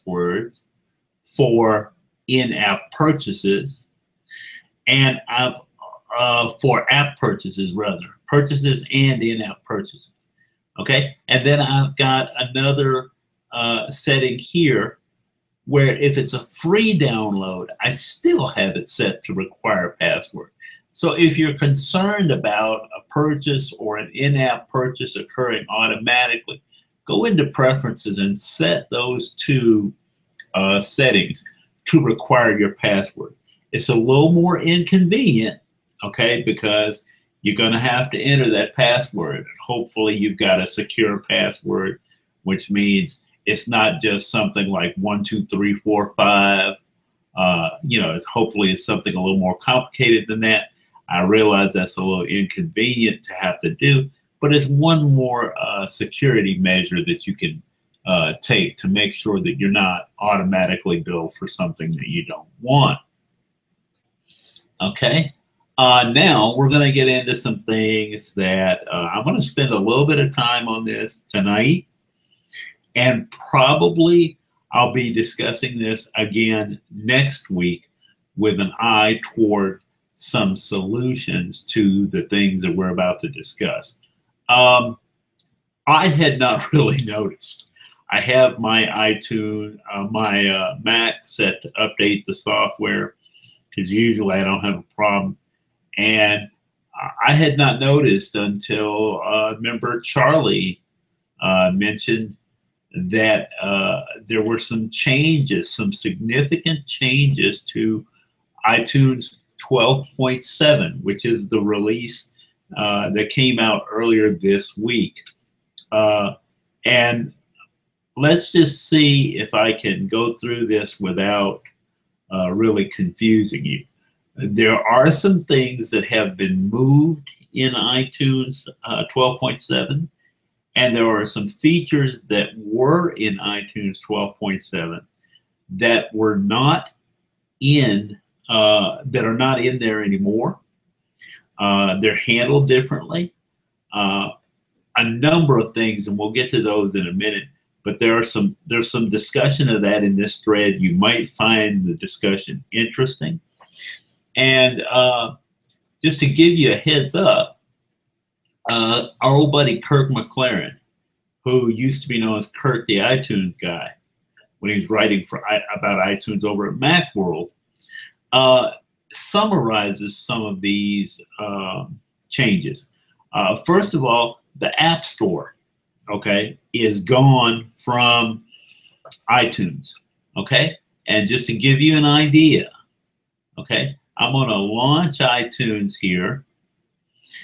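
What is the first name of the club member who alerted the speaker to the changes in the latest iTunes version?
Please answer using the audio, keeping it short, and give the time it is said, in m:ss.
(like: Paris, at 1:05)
Charlie, at 1:40.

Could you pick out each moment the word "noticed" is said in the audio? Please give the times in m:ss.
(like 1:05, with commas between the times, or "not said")
1:27, 1:37.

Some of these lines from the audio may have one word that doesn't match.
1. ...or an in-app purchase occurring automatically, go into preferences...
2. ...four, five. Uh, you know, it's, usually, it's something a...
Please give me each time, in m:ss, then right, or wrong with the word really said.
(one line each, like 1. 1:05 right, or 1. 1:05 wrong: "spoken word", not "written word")
1. 0:23 right
2. 0:45 wrong: "hopefully", not "usually".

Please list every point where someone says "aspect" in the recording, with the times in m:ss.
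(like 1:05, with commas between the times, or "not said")
not said.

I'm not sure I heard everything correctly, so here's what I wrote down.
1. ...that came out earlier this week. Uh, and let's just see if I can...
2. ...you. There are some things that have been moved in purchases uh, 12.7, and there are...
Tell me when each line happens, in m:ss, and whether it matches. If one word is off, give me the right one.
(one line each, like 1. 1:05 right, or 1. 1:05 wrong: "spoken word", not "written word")
1. 1:53 right
2. 2:03 wrong: "iTunes", not "purchases".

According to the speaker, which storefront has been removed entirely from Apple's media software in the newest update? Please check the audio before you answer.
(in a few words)
The App Store.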